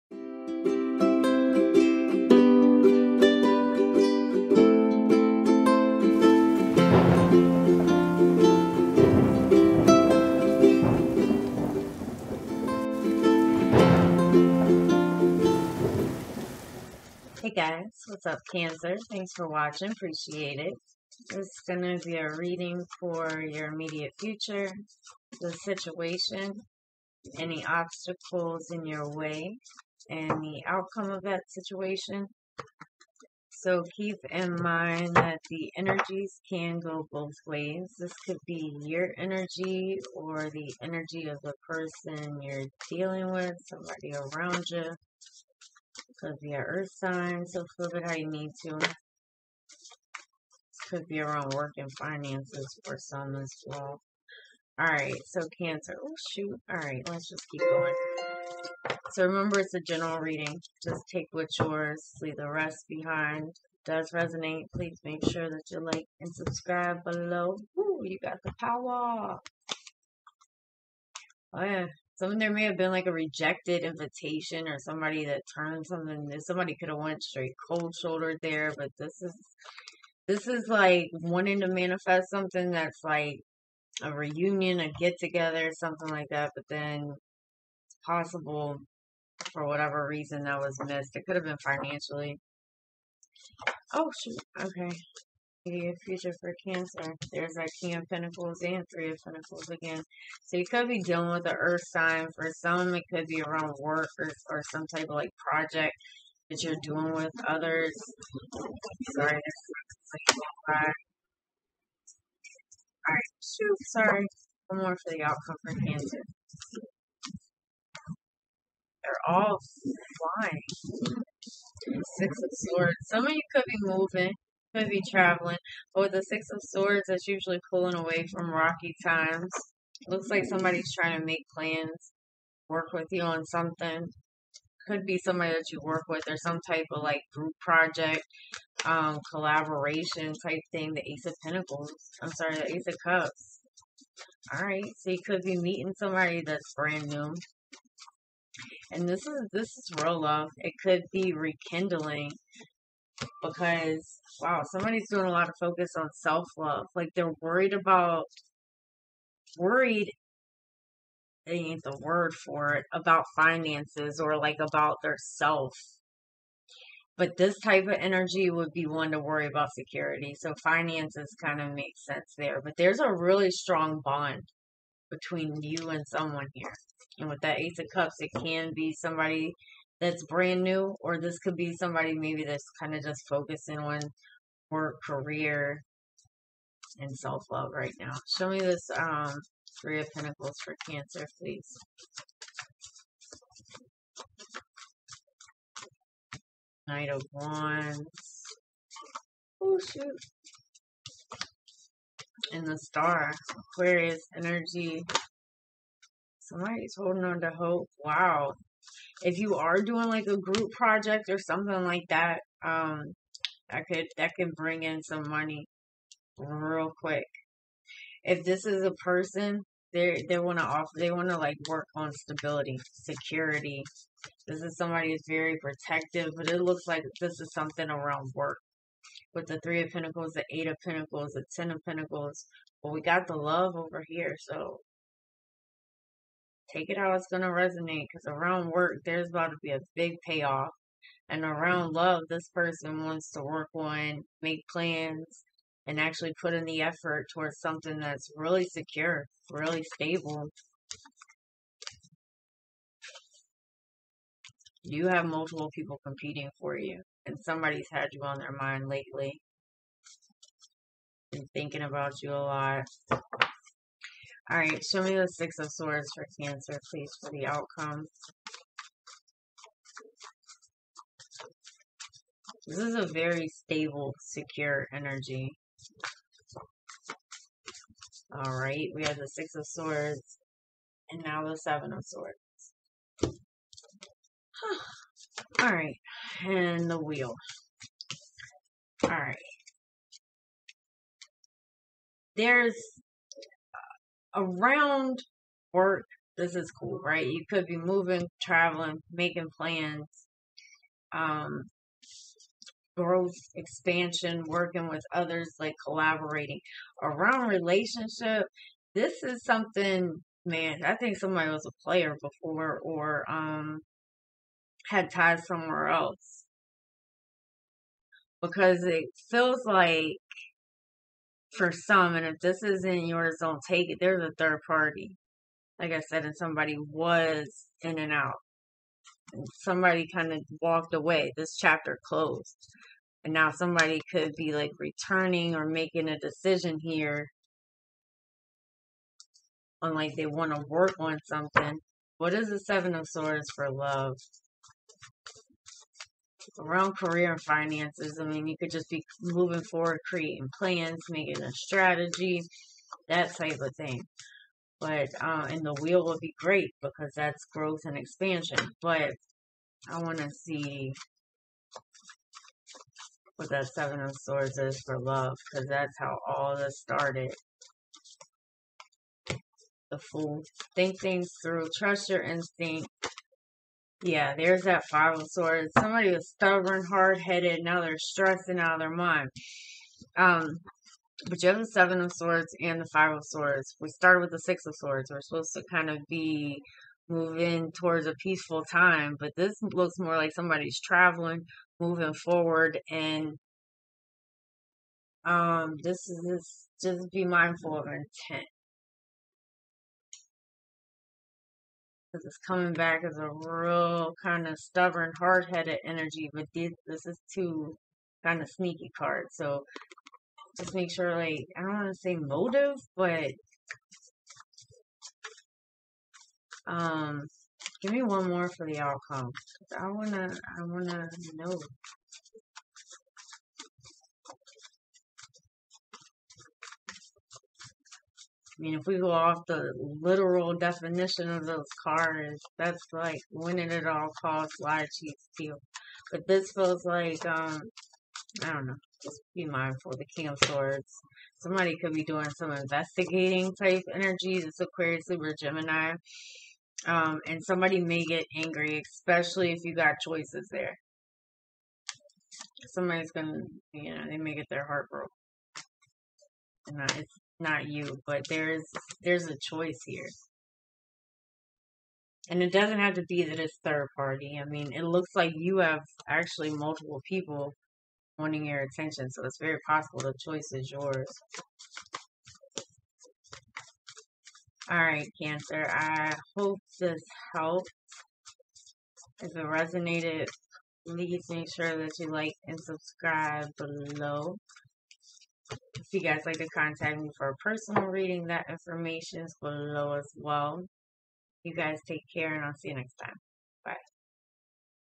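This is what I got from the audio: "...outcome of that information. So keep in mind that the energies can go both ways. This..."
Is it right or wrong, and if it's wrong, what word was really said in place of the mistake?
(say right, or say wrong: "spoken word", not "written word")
wrong: "situation", not "information".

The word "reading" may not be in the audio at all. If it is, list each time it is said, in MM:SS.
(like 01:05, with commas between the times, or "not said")
00:22, 01:00, 08:07.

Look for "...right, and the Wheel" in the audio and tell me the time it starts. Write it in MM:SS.
04:45.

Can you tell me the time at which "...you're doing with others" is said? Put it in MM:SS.
01:46.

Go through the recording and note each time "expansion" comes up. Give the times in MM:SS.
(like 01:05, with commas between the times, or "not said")
05:03, 05:57.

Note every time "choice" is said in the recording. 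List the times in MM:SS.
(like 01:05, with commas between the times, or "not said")
07:30, 07:39, 07:50.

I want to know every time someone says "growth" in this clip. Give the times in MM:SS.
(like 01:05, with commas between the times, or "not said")
05:02, 05:57.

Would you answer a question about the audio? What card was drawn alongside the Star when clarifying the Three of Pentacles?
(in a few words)
Knight of Wands.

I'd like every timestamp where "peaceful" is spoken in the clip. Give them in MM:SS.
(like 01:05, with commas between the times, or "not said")
06:28.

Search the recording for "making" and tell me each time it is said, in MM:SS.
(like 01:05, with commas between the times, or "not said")
04:59, 05:35, 05:51.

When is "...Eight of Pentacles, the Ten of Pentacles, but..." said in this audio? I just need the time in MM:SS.
03:50.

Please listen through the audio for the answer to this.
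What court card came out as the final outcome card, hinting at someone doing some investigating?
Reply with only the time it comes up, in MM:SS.
07:19.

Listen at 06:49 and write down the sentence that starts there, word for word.
So just make sure, like, I don't want to say motive, but um, give me one more for the outcome.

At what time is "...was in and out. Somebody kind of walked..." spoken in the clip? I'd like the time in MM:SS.
05:26.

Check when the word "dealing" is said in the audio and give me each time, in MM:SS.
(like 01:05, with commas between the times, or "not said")
00:42, 01:41.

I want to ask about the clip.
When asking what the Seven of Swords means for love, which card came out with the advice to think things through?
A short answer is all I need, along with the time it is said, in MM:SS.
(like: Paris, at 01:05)
The Fool, at 06:09.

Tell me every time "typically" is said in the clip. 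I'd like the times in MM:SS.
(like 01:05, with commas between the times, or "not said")
not said.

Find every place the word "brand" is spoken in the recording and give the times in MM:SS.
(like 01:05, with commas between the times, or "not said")
02:26, 03:00.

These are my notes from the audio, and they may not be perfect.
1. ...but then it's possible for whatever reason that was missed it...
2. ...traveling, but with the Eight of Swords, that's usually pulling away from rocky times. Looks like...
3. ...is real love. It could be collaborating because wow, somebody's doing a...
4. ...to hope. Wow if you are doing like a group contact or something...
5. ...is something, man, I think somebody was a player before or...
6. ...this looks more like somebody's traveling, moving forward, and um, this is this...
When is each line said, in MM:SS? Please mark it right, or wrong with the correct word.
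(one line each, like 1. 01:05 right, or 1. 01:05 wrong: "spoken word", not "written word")
1. 01:26 right
2. 02:05 wrong: "Six", not "Eight"
3. 02:29 wrong: "rekindling", not "collaborating"
4. 03:27 wrong: "project", not "contact"
5. 05:09 right
6. 06:29 right.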